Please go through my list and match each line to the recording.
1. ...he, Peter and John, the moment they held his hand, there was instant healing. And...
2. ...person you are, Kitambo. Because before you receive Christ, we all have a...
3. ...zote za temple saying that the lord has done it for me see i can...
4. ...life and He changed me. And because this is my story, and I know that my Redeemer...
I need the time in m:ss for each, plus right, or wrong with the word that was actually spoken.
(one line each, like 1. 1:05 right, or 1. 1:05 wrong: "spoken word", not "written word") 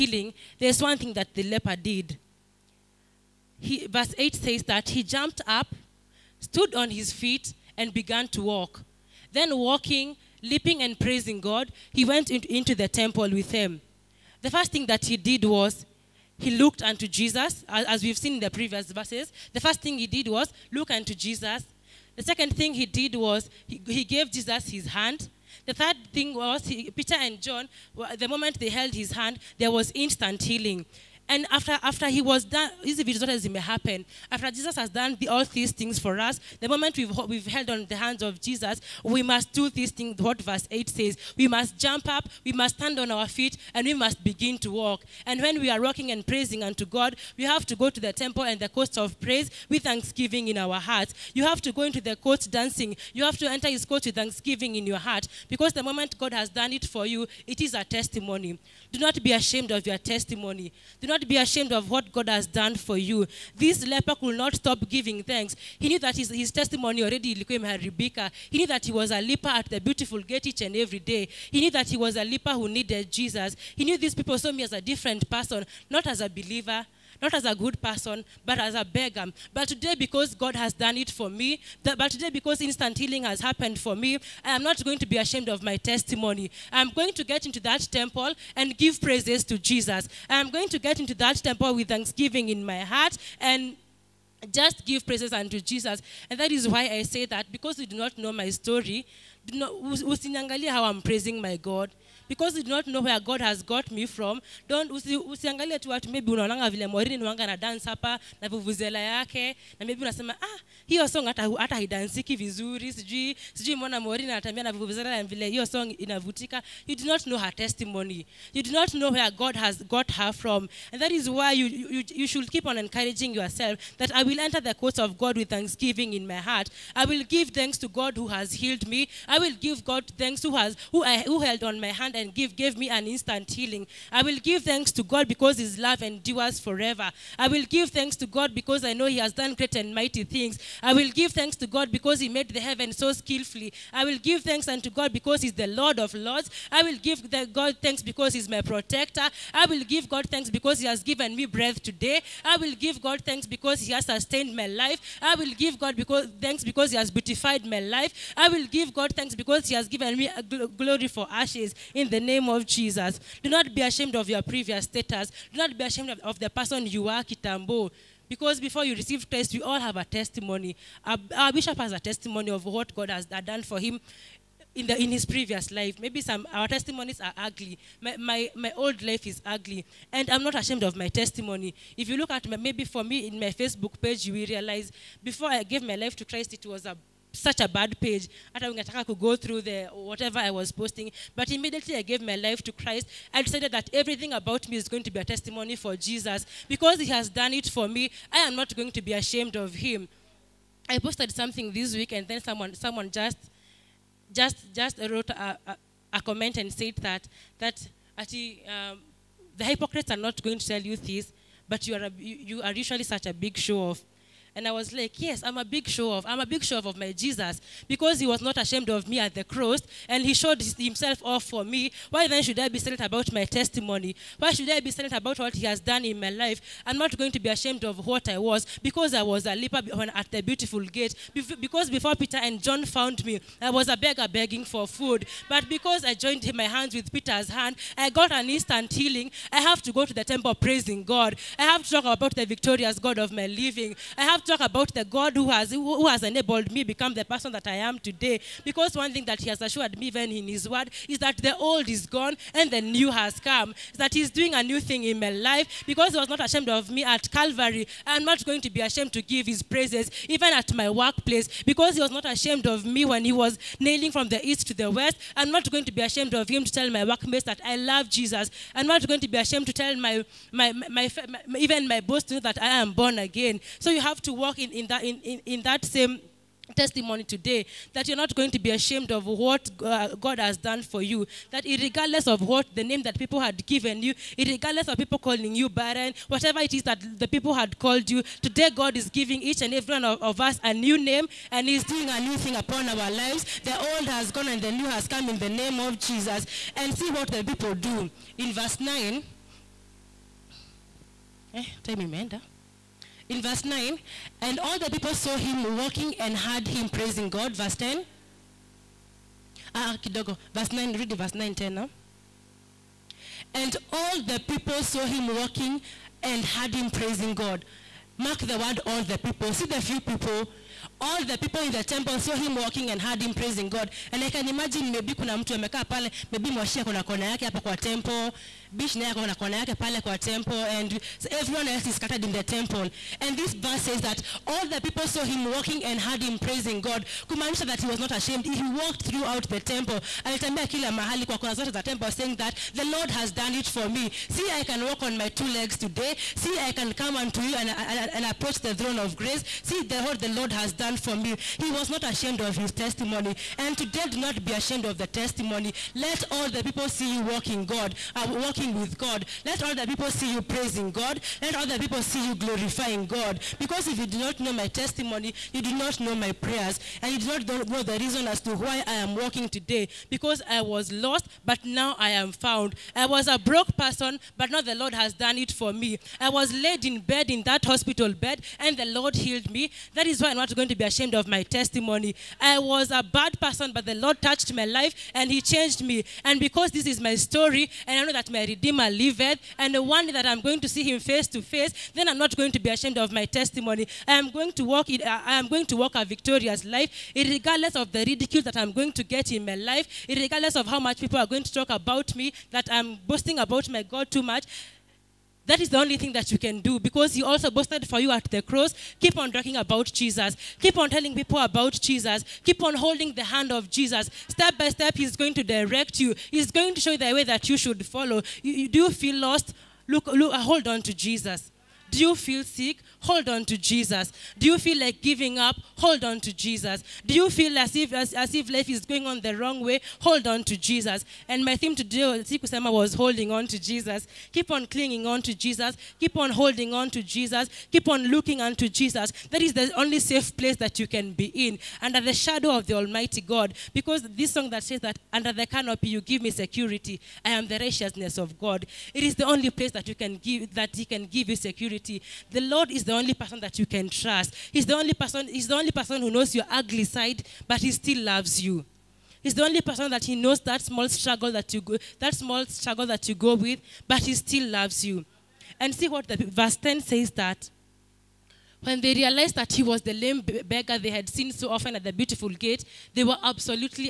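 1. 0:26 right
2. 2:46 right
3. 5:41 right
4. 6:24 right.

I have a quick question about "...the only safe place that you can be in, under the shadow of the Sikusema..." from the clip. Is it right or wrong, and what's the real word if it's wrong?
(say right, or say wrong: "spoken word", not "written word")
wrong: "Almighty", not "Sikusema".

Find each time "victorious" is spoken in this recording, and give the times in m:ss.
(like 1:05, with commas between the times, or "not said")
4:02, 6:36.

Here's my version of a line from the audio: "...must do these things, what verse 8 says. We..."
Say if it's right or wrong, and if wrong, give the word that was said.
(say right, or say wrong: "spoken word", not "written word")
right.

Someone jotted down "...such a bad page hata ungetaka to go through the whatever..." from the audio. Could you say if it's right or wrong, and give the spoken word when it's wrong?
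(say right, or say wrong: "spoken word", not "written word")
right.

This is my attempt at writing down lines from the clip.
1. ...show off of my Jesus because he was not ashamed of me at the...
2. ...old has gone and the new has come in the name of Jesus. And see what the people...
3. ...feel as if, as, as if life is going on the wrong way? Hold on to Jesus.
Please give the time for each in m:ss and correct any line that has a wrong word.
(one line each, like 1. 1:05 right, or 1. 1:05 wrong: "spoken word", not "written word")
1. 3:36 right
2. 4:53 right
3. 7:07 right.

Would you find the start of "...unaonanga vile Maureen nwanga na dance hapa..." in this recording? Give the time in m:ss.
1:46.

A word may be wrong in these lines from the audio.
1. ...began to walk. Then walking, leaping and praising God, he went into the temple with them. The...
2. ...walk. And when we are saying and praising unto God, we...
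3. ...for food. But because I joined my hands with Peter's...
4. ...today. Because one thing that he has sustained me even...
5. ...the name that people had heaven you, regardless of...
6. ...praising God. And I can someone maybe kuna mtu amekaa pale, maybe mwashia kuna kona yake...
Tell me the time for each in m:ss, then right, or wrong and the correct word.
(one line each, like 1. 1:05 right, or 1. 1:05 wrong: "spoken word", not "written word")
1. 0:07 right
2. 0:44 wrong: "walking", not "saying"
3. 3:54 right
4. 4:07 wrong: "assured", not "sustained"
5. 4:42 wrong: "given", not "heaven"
6. 5:23 wrong: "imagine", not "someone".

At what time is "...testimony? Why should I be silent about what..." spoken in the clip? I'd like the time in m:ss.
3:43.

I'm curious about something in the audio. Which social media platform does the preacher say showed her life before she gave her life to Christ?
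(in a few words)
Facebook.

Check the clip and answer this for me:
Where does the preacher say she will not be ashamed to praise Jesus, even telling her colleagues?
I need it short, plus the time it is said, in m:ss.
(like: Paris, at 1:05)
Workplace, at 4:20.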